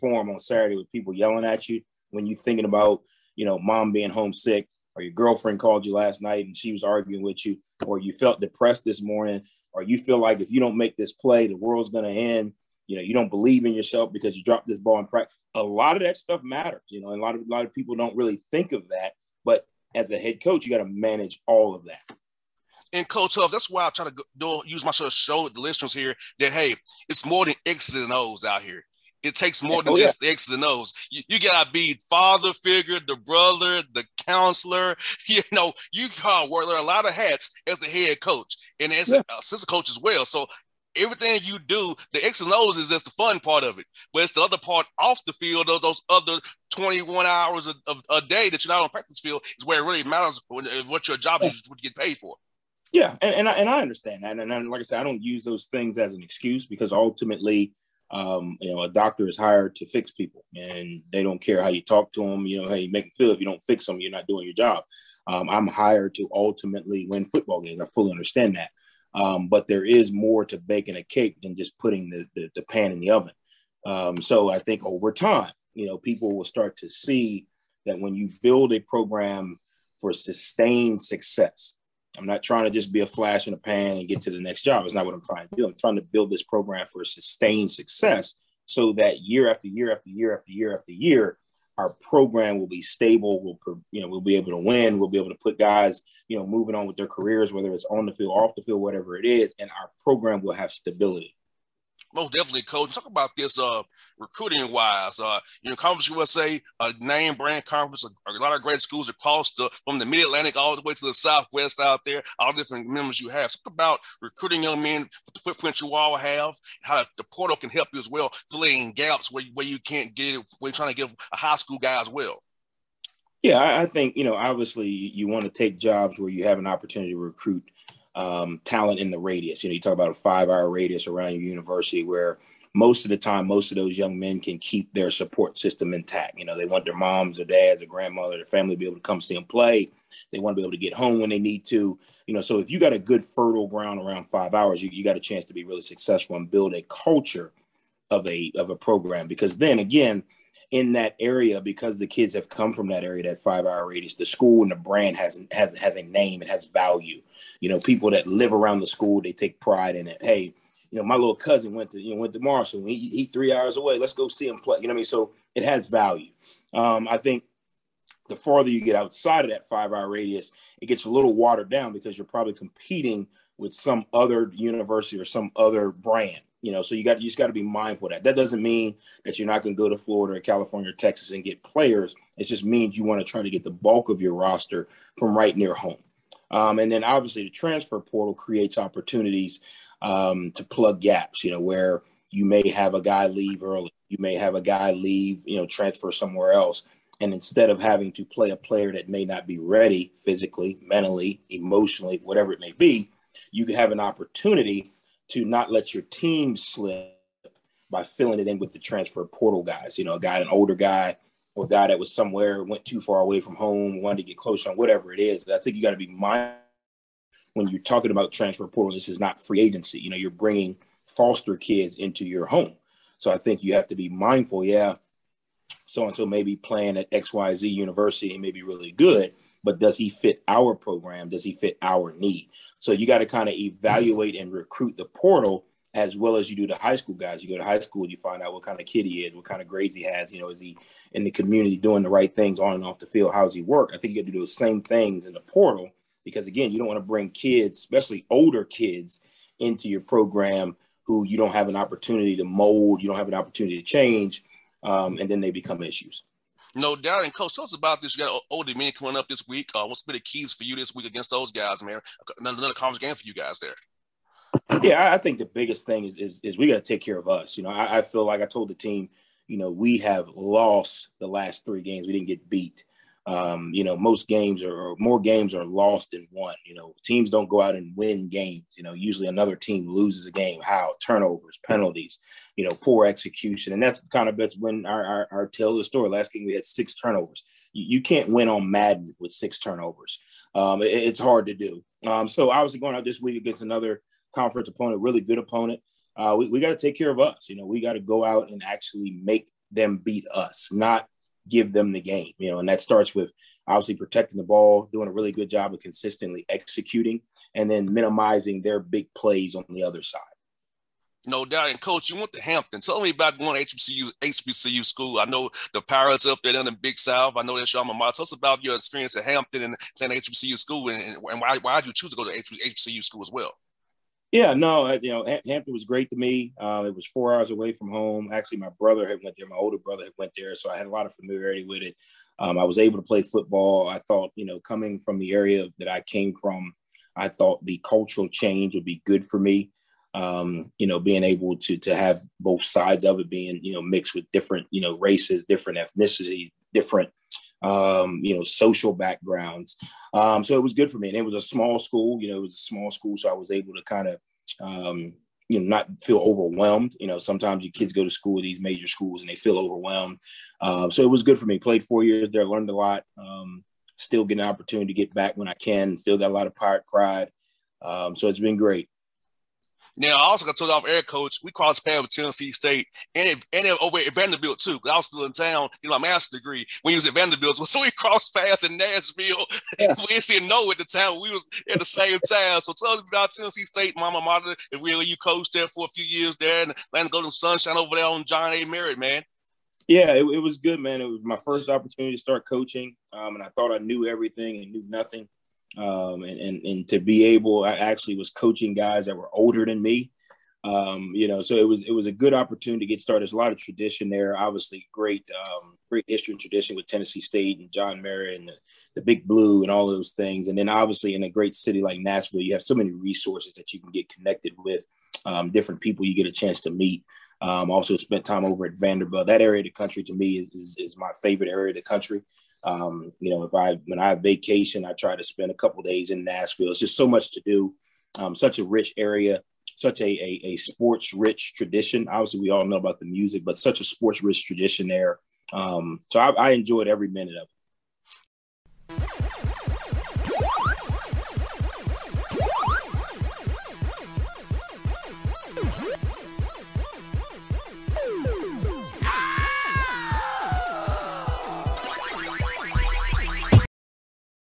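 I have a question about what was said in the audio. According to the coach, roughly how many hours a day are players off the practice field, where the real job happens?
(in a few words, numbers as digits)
21.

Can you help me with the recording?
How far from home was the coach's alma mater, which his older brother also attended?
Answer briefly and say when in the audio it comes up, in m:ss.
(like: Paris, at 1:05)
4 hours, at 5:27.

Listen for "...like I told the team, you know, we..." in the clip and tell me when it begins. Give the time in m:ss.
4:28.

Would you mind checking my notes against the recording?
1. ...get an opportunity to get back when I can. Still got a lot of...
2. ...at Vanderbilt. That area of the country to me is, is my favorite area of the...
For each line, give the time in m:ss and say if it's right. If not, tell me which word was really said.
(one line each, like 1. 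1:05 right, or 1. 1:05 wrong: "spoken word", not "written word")
1. 6:04 right
2. 6:58 right.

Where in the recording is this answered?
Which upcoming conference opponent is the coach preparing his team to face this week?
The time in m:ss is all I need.
4:18.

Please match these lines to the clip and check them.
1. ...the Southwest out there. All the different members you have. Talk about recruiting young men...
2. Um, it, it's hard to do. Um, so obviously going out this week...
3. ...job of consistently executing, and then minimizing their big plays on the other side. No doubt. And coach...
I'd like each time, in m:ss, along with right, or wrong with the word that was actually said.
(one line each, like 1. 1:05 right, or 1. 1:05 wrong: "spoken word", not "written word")
1. 1:51 right
2. 4:50 right
3. 5:05 right.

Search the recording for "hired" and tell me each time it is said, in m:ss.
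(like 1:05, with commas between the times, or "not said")
0:59, 1:05.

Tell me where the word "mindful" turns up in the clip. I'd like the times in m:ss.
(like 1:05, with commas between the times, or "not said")
2:57, 3:36, 3:44.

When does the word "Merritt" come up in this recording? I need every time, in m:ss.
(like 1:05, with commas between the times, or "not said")
6:28, 6:48.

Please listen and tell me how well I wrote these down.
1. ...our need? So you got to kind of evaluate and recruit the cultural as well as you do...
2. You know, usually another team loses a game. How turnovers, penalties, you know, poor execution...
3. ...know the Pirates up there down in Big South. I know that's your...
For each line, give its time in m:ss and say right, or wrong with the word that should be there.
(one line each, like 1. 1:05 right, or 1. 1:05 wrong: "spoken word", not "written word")
1. 3:51 wrong: "portal", not "cultural"
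2. 4:38 right
3. 5:15 right.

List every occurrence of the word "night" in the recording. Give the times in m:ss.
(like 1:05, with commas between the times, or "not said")
0:06.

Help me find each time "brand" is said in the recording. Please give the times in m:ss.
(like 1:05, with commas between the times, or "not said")
1:47, 2:34, 2:55.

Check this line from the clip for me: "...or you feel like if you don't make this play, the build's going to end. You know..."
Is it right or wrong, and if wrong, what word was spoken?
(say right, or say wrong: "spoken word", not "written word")
wrong: "world", not "build".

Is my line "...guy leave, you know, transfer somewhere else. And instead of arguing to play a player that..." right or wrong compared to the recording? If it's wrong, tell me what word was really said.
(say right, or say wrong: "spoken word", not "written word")
wrong: "having", not "arguing".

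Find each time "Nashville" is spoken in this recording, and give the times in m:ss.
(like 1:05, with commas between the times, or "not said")
6:18, 6:52, 7:06.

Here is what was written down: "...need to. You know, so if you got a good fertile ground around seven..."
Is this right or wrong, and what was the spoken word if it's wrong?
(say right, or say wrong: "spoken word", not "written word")
wrong: "five", not "seven".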